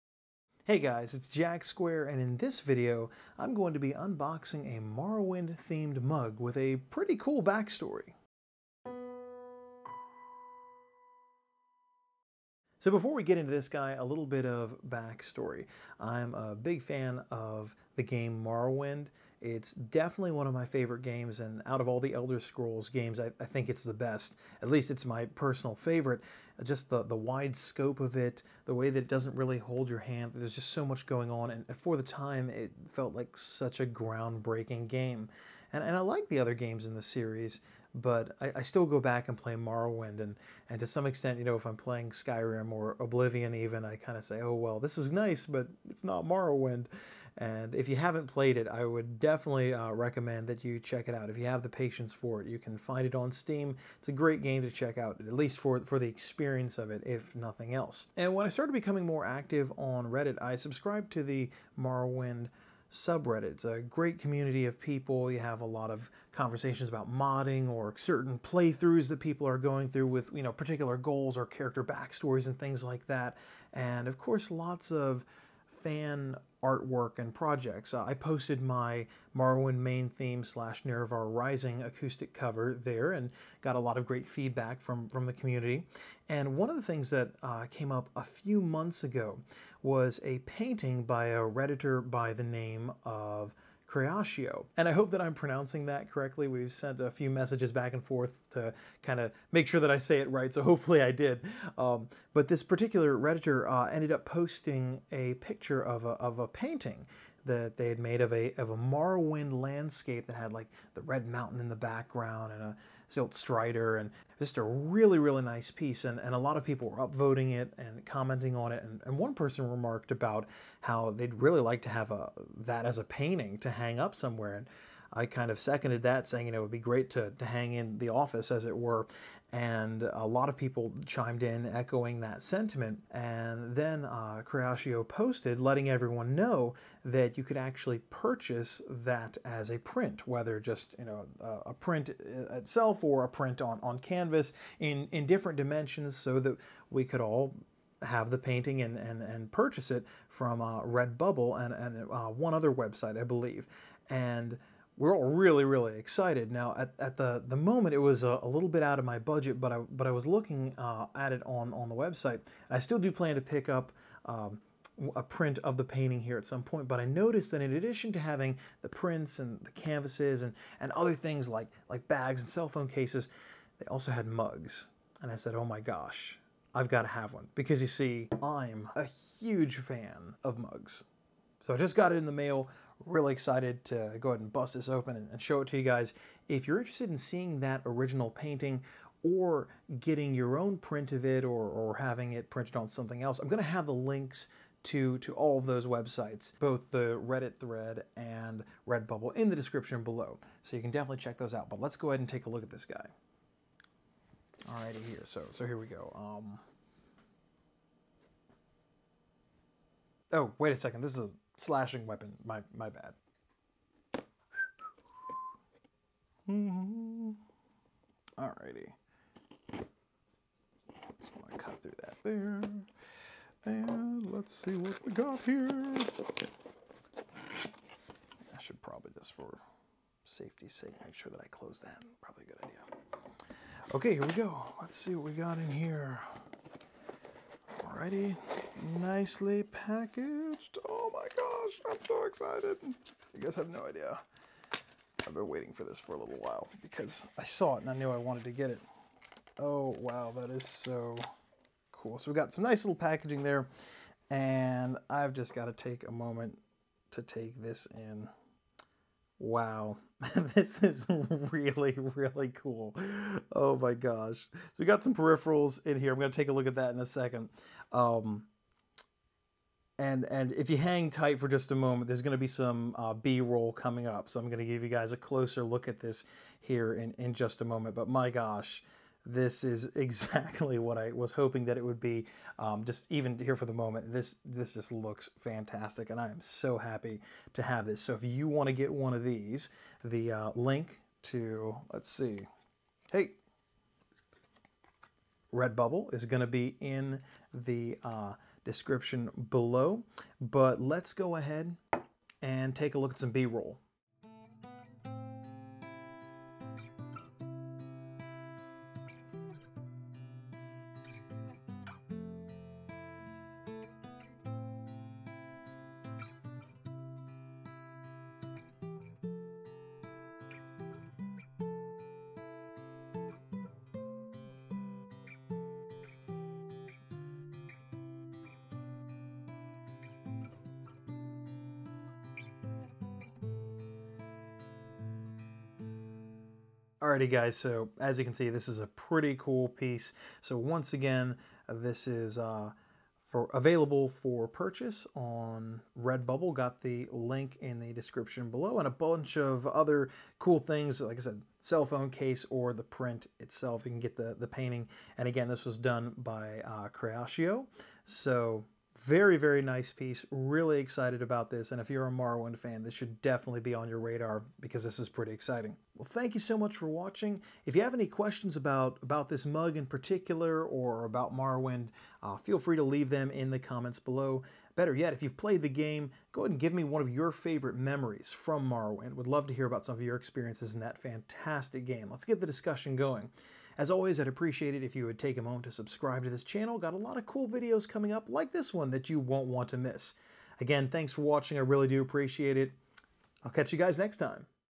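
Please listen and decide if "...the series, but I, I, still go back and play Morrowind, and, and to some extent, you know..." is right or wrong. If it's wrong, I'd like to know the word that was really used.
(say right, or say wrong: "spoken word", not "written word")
right.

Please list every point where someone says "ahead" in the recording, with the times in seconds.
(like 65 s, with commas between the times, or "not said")
184 s, 202 s, 301 s, 376 s.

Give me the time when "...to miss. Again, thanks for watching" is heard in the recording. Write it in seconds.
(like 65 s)
389 s.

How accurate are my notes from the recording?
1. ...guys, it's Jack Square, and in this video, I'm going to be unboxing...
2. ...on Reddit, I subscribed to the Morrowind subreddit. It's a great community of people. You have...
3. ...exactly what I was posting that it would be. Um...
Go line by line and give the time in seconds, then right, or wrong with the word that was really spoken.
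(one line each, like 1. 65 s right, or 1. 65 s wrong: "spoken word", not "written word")
1. 0 s right
2. 59 s right
3. 279 s wrong: "hoping", not "posting".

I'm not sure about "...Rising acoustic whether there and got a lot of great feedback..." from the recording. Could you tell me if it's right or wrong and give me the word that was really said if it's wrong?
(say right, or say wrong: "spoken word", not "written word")
wrong: "cover", not "whether".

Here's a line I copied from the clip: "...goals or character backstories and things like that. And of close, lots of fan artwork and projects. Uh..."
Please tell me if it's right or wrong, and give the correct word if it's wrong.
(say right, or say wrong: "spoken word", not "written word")
wrong: "course", not "close".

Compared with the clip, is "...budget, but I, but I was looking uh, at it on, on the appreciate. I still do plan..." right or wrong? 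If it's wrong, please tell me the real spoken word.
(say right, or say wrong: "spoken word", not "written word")
wrong: "website", not "appreciate".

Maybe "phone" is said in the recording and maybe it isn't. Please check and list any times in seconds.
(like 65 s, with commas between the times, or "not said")
172 s, 351 s.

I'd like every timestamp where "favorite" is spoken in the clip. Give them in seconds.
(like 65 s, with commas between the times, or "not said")
20 s, 25 s, 377 s.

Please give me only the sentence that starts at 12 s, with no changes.
So before we get into this guy, a little bit of backstory.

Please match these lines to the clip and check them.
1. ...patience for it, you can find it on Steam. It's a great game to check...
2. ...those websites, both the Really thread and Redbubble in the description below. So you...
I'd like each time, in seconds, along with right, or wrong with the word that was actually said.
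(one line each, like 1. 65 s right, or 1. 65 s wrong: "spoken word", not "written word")
1. 51 s right
2. 195 s wrong: "Reddit", not "Really".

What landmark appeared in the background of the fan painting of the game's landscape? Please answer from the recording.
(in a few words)
Red Mountain.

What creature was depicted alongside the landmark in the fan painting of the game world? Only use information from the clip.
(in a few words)
Silt Strider.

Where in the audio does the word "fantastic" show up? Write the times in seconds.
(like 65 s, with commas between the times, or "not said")
285 s, 380 s.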